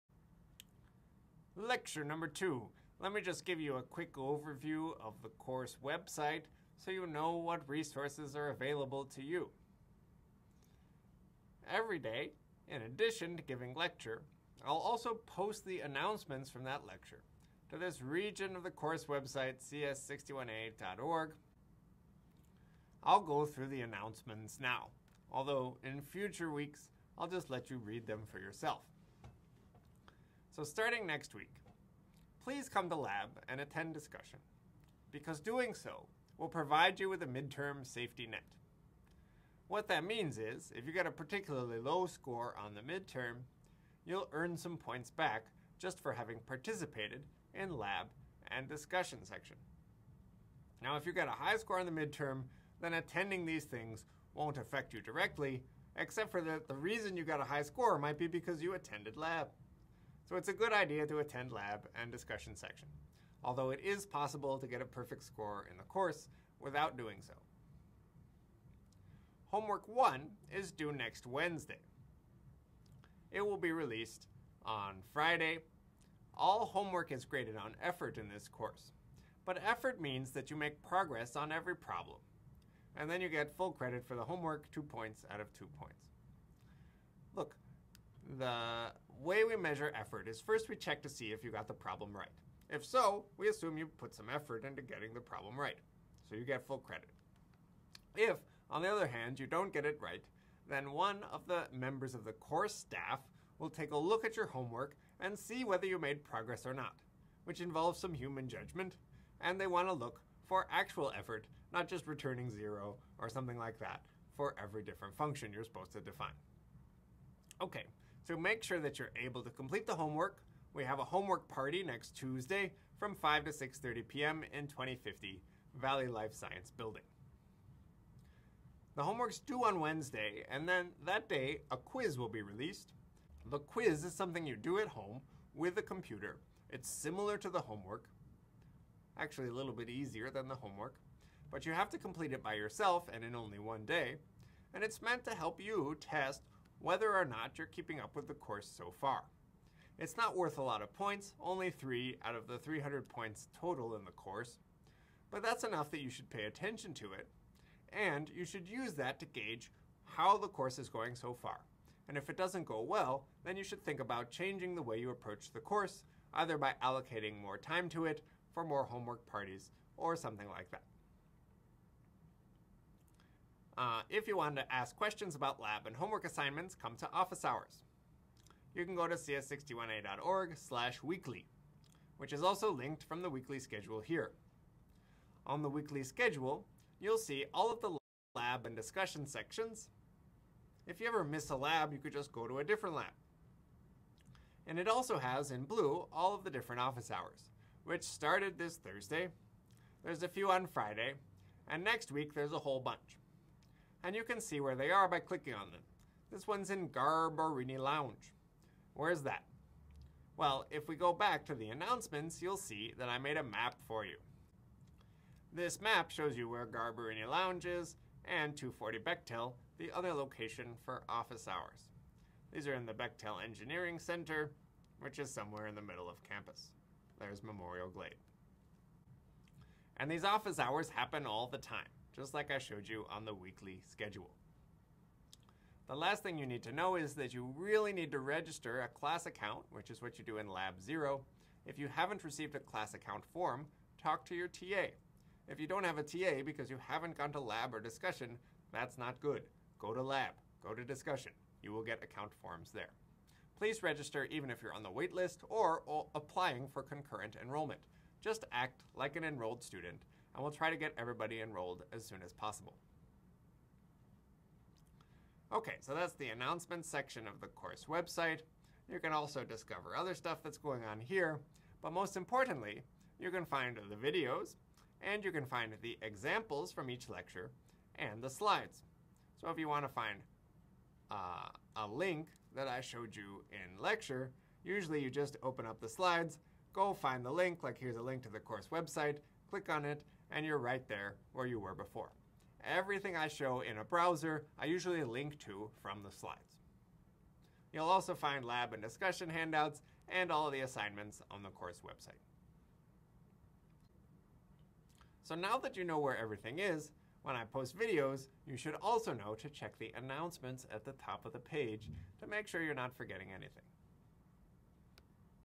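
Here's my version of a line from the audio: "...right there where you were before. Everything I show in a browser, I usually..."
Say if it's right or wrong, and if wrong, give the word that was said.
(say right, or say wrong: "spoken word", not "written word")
right.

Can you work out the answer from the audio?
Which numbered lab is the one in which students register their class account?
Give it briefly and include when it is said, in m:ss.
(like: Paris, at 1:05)
Lab 0, at 4:00.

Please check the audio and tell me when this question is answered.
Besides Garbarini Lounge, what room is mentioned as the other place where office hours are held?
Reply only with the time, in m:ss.
3:38.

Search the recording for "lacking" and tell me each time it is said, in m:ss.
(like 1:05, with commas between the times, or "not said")
not said.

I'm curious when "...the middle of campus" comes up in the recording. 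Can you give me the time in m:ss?
3:45.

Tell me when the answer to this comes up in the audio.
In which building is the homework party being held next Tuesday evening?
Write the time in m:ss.
2:05.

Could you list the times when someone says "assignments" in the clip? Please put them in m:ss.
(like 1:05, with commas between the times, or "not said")
2:56, 5:00.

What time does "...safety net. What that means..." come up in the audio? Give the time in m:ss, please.
0:37.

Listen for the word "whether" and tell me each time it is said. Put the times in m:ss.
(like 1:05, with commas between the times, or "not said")
1:45, 2:26.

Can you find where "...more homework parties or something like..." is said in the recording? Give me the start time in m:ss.
2:48.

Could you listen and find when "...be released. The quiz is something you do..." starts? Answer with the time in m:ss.
2:12.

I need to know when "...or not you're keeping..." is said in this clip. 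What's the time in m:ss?
2:27.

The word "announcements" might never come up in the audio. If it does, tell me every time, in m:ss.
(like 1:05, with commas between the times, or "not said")
0:15, 0:23, 3:31, 4:26, 5:09.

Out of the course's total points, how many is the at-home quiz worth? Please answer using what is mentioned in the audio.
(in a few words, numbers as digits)
3.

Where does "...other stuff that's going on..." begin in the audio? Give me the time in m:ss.
4:29.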